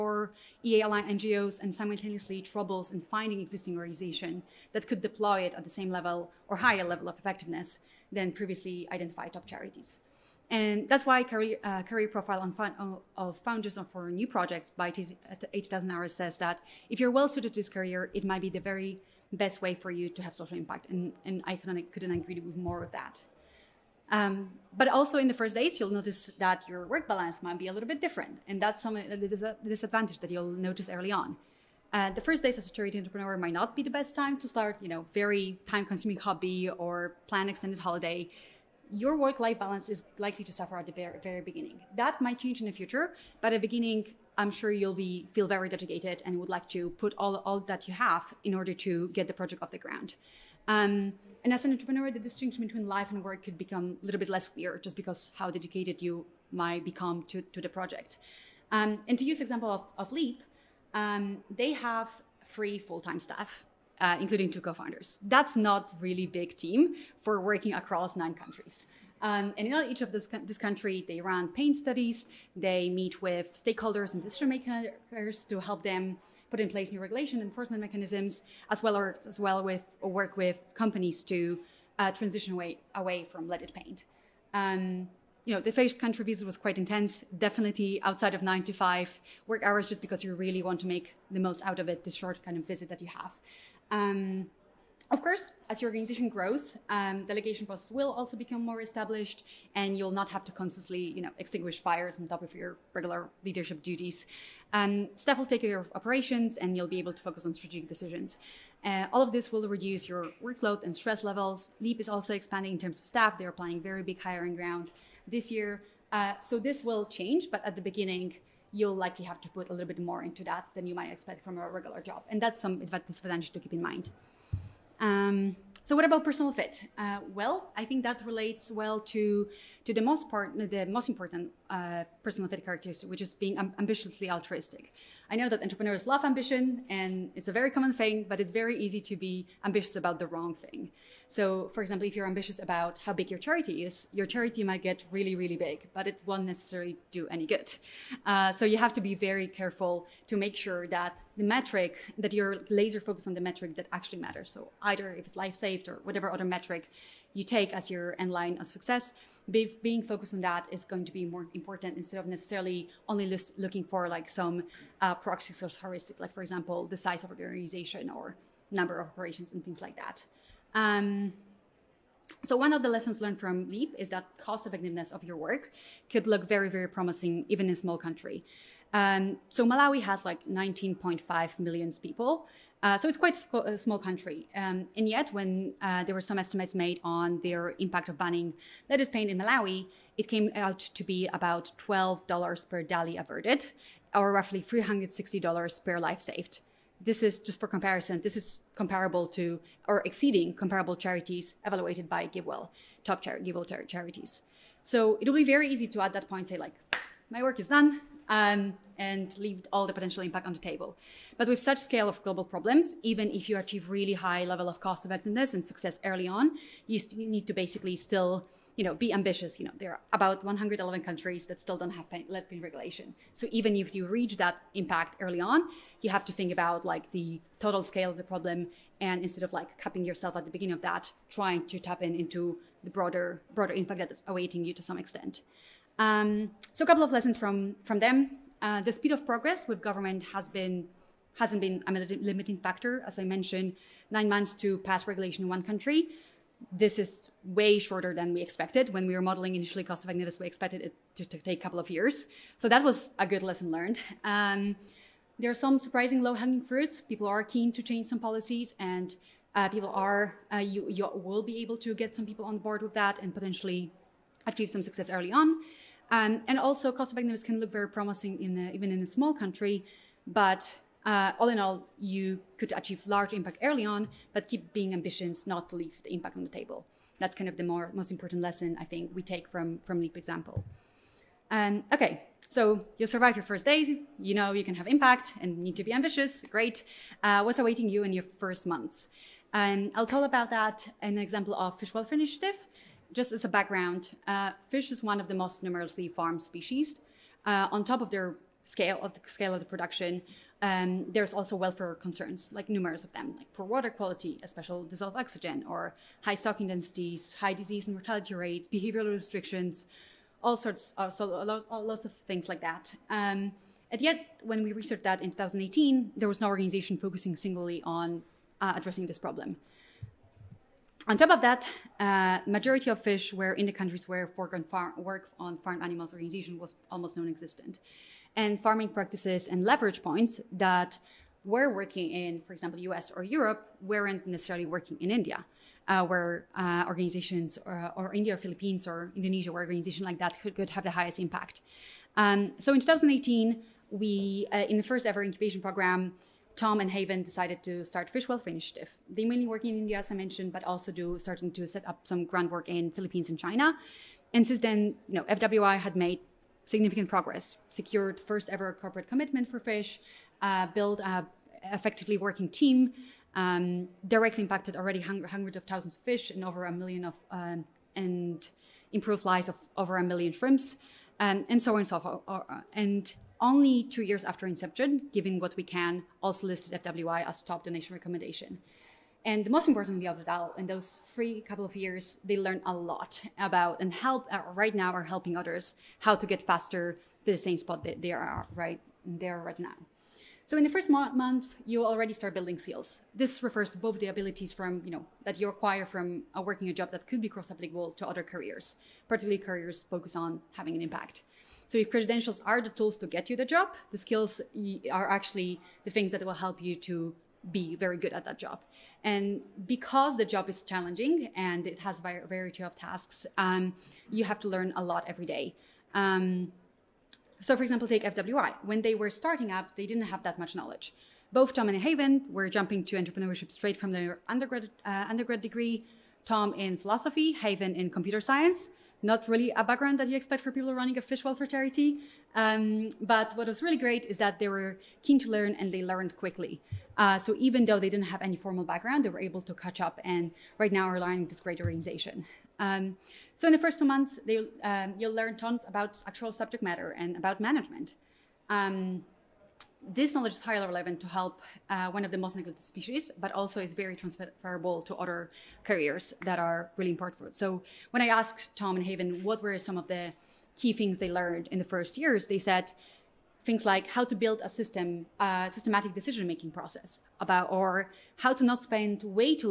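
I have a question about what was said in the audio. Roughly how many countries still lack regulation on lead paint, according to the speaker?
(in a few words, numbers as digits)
111.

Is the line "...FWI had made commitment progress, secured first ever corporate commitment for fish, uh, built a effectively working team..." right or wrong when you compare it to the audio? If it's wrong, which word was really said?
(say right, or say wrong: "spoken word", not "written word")
wrong: "significant", not "commitment".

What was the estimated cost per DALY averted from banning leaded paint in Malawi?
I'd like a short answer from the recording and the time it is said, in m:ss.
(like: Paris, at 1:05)
$12, at 3:11.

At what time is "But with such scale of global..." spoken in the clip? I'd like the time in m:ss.
3:31.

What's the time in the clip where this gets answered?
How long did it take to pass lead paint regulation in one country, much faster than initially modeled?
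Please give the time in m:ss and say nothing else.
4:04.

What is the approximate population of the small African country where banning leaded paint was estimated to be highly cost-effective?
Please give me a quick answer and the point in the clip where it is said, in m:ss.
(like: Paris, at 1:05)
19.5 million, at 3:00.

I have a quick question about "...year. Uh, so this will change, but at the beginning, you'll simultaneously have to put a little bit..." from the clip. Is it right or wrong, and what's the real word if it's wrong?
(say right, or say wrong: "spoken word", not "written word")
wrong: "likely", not "simultaneously".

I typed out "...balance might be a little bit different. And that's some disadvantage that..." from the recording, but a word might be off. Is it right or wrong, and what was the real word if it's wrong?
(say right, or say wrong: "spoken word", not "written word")
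right.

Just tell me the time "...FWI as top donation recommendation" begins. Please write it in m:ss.
6:16.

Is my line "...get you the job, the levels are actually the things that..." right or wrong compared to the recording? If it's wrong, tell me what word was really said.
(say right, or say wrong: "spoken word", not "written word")
wrong: "skills", not "levels".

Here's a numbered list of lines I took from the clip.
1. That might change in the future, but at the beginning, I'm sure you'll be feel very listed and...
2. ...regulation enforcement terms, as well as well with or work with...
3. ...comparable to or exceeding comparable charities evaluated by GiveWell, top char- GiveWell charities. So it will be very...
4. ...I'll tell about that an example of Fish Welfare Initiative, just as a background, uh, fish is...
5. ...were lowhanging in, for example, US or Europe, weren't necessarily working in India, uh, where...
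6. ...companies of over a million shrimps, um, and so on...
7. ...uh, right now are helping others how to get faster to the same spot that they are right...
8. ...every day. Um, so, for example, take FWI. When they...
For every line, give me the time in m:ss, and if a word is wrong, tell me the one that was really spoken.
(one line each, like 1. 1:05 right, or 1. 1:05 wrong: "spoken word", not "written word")
1. 0:41 wrong: "dedicated", not "listed"
2. 1:17 wrong: "mechanisms", not "terms"
3. 3:18 right
4. 4:49 right
5. 5:31 wrong: "working", not "lowhanging"
6. 6:09 wrong: "lives", not "companies"
7. 6:24 right
8. 6:55 right.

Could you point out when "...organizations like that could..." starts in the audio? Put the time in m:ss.
5:39.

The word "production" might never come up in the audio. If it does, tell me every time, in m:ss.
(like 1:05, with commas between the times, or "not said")
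4:59.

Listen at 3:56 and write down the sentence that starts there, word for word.
Um, so a couple of lessons from, from them.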